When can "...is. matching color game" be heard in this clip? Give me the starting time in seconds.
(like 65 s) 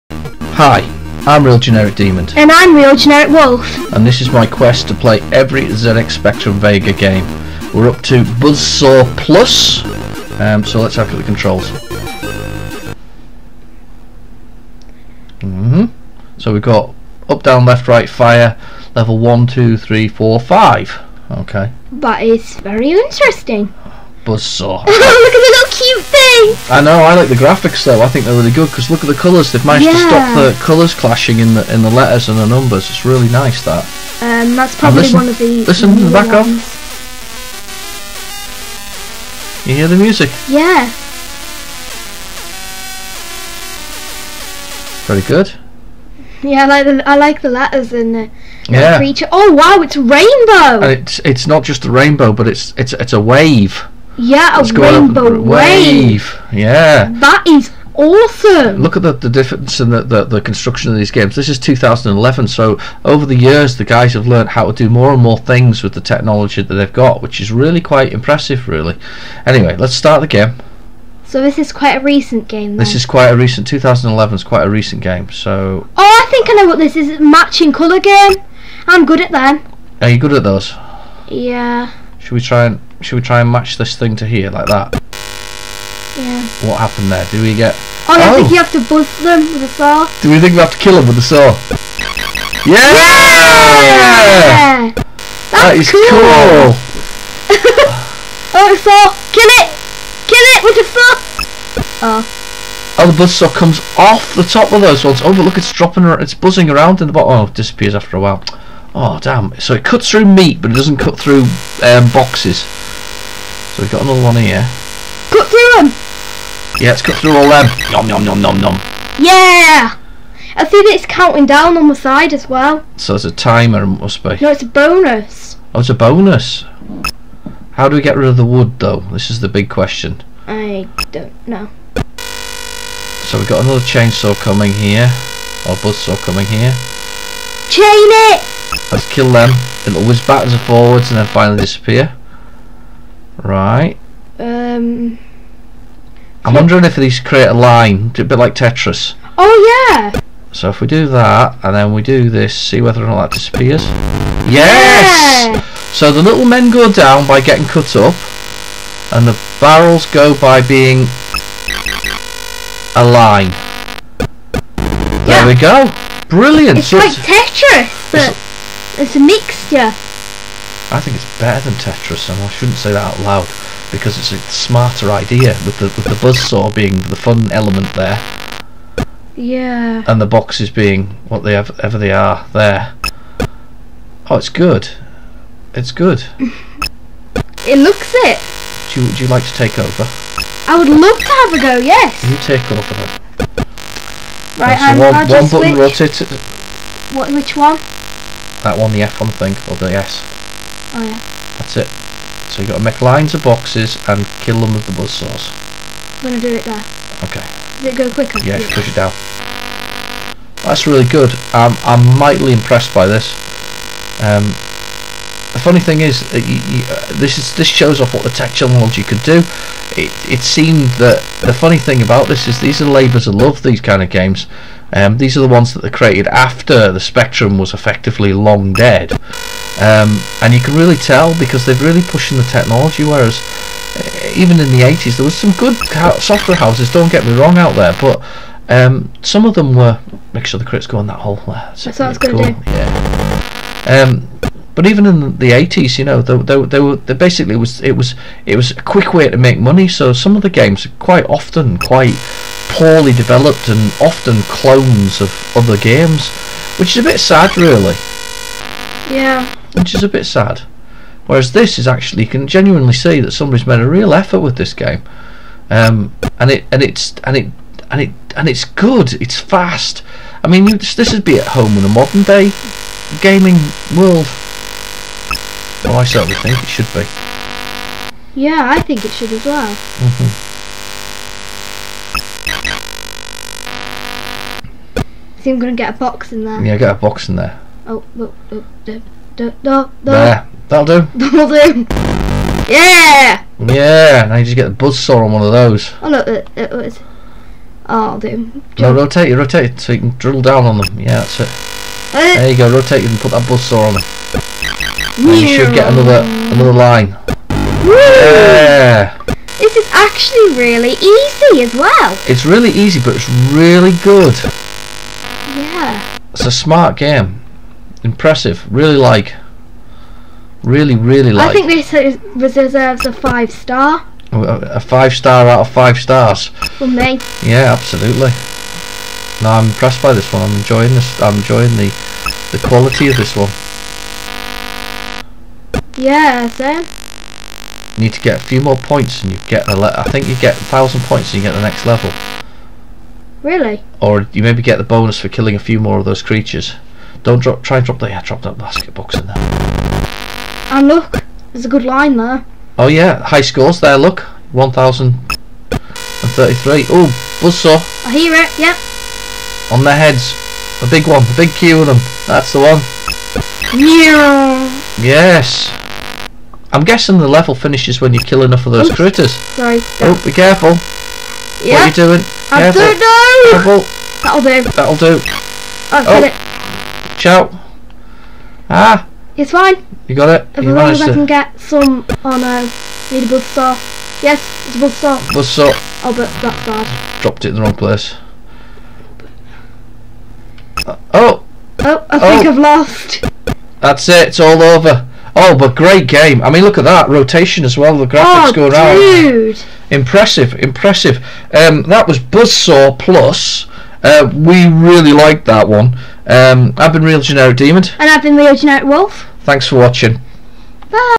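76 s.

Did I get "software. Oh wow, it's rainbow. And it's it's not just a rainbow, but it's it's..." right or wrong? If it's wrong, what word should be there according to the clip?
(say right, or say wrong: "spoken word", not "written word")
wrong: "creature", not "software".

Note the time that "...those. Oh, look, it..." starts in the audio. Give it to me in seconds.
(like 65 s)
295 s.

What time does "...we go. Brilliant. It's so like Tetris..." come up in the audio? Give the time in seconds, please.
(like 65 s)
165 s.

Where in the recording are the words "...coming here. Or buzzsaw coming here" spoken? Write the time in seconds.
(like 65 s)
134 s.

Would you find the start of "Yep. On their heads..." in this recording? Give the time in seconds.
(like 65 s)
358 s.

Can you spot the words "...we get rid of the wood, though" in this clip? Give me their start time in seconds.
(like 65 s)
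127 s.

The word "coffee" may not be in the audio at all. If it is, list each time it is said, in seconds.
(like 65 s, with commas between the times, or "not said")
not said.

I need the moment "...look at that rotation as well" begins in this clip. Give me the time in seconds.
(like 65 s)
396 s.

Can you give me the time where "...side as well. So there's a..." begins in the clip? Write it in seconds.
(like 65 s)
121 s.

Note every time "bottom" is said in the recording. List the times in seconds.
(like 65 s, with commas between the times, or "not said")
107 s.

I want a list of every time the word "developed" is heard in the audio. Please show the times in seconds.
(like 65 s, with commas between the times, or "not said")
253 s.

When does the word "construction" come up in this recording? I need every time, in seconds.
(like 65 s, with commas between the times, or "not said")
60 s.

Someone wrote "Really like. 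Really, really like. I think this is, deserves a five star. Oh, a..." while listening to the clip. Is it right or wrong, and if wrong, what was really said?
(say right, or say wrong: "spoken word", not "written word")
right.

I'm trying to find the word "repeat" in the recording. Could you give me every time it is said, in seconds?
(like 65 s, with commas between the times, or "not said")
not said.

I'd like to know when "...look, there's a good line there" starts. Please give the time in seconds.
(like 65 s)
350 s.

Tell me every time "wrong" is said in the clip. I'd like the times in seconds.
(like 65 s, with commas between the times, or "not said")
237 s, 387 s.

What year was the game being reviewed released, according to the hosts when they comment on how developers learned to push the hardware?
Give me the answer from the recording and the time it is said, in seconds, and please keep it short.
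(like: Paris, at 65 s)
2011, at 61 s.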